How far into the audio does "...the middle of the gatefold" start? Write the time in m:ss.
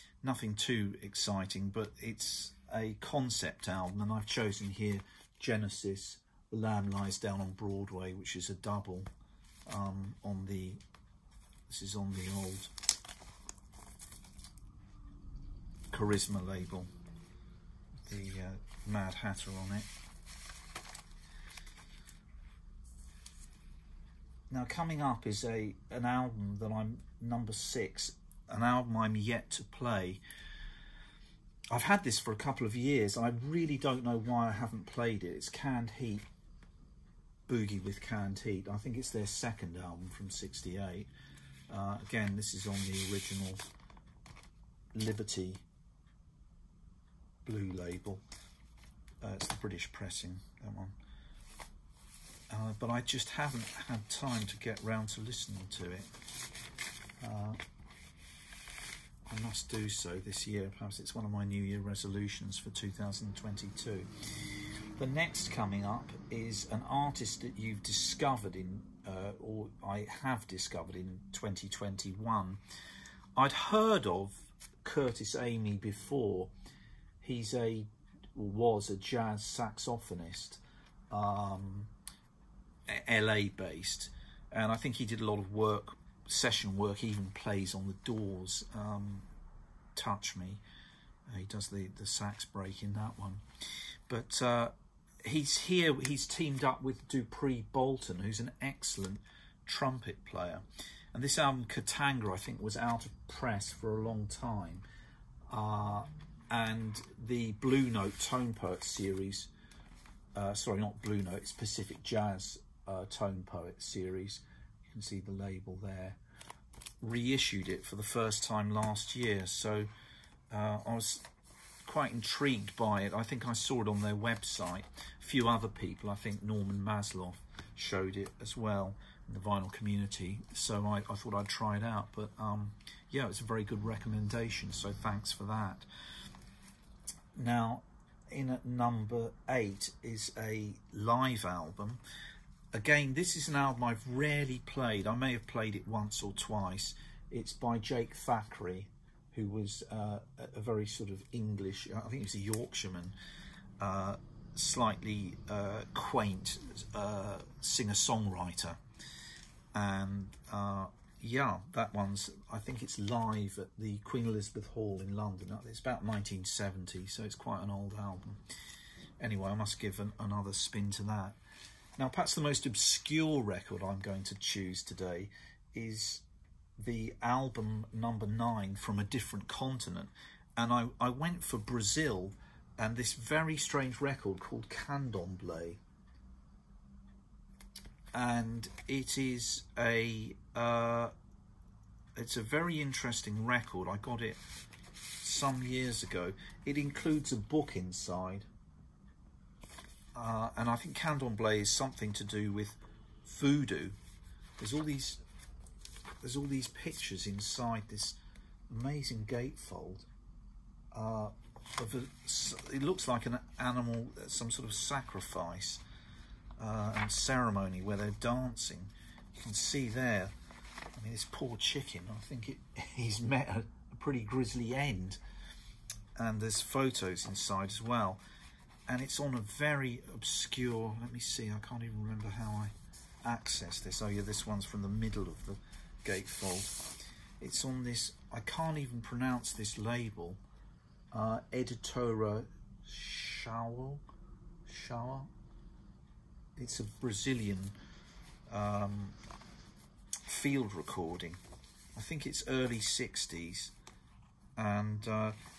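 3:54.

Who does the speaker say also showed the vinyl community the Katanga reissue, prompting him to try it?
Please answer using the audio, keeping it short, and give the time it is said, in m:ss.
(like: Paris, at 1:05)
Norman Masloff, at 2:06.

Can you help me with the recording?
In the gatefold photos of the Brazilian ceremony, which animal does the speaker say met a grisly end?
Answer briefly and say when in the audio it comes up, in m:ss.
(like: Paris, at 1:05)
Chicken, at 3:41.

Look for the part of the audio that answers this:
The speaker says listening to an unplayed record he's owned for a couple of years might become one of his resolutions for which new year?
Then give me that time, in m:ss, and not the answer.
1:02.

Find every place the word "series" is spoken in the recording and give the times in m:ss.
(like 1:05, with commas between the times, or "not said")
1:48, 1:53.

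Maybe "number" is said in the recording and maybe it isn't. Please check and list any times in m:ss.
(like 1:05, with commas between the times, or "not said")
0:27, 2:18, 2:57.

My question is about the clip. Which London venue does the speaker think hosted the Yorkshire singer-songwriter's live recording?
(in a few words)
Queen Elizabeth Hall.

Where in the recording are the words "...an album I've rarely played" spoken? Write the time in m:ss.
2:23.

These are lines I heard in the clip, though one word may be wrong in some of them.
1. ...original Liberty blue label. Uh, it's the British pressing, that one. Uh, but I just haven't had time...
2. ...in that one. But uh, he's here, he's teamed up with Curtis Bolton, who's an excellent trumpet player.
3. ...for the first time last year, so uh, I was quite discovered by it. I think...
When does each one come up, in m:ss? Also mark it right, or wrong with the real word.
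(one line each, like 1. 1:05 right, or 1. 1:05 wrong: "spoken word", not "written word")
1. 0:43 right
2. 1:32 wrong: "Dupree", not "Curtis"
3. 1:57 wrong: "intrigued", not "discovered".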